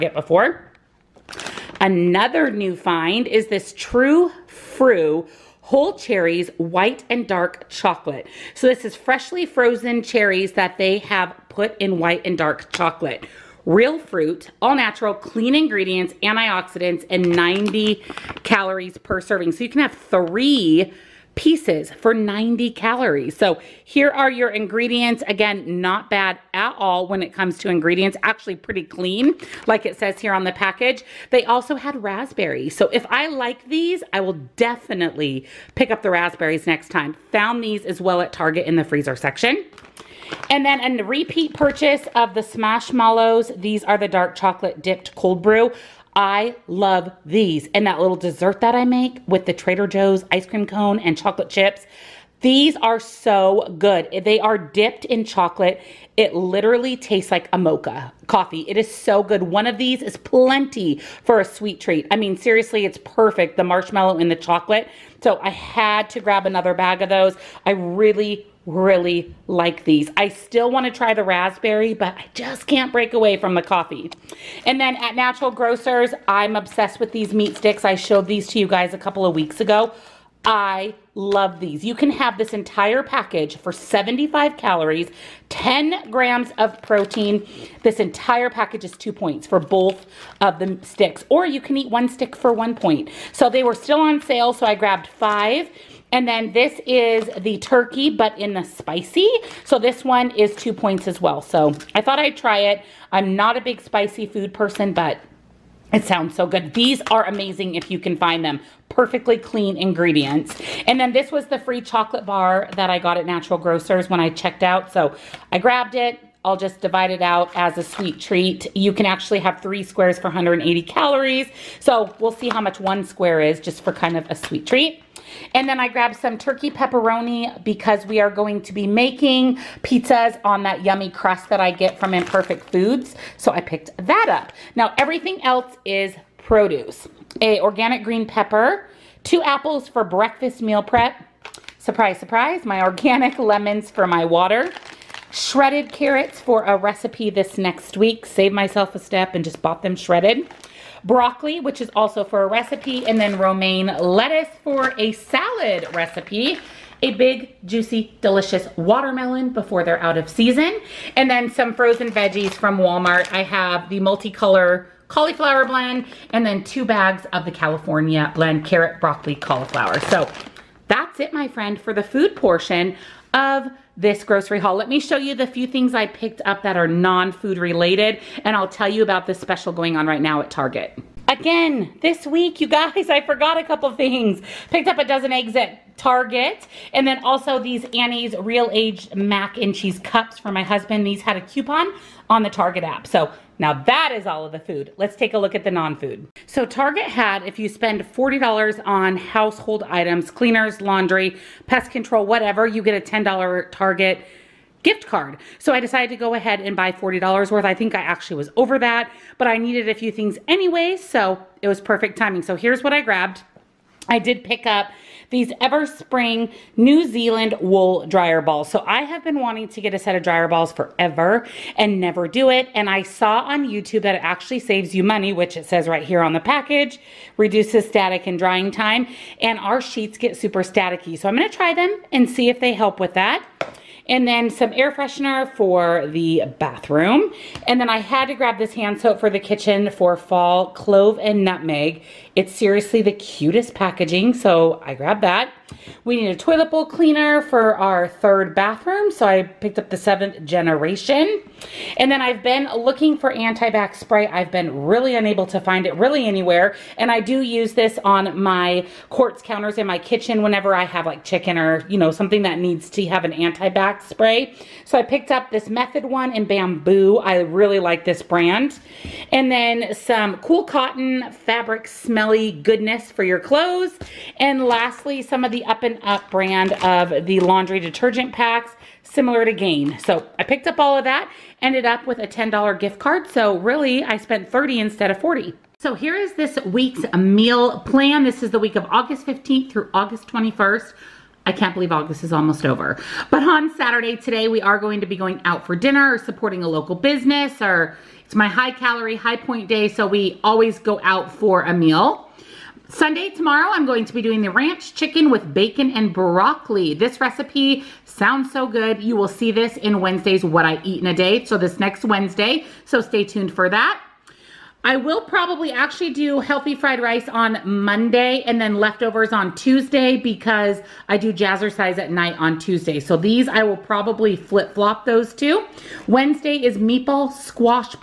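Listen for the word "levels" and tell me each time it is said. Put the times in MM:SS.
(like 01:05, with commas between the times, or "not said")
not said.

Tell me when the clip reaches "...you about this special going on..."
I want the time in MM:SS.
02:58.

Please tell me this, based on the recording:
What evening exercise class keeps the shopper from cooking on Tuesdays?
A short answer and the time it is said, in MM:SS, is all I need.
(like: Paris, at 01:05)
Jazzercise, at 05:21.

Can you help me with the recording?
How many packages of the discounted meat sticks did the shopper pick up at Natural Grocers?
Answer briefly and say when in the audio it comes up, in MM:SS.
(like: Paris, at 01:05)
5, at 01:35.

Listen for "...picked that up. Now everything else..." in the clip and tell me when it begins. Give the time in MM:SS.
02:13.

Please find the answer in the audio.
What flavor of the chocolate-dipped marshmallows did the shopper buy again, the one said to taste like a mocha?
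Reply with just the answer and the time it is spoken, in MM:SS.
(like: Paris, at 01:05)
Cold brew, at 00:45.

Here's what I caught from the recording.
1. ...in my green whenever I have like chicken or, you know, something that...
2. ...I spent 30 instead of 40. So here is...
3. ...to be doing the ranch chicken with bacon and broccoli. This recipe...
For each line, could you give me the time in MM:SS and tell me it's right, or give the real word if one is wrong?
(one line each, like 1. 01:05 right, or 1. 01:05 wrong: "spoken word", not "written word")
1. 04:19 wrong: "kitchen", not "green"
2. 04:44 right
3. 05:04 right.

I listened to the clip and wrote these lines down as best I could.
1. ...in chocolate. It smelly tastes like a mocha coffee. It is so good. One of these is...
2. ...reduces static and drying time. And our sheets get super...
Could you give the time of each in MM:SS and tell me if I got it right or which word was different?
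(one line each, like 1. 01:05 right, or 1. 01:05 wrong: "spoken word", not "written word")
1. 00:55 wrong: "literally", not "smelly"
2. 03:47 right.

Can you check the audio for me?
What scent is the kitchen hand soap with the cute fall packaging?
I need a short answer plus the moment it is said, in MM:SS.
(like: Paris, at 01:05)
Clove and nutmeg, at 04:00.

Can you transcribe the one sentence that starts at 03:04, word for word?
Picked up a dozen eggs at Target.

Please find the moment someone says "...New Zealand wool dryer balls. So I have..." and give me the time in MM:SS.
03:36.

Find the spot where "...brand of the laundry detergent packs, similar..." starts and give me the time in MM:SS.
04:36.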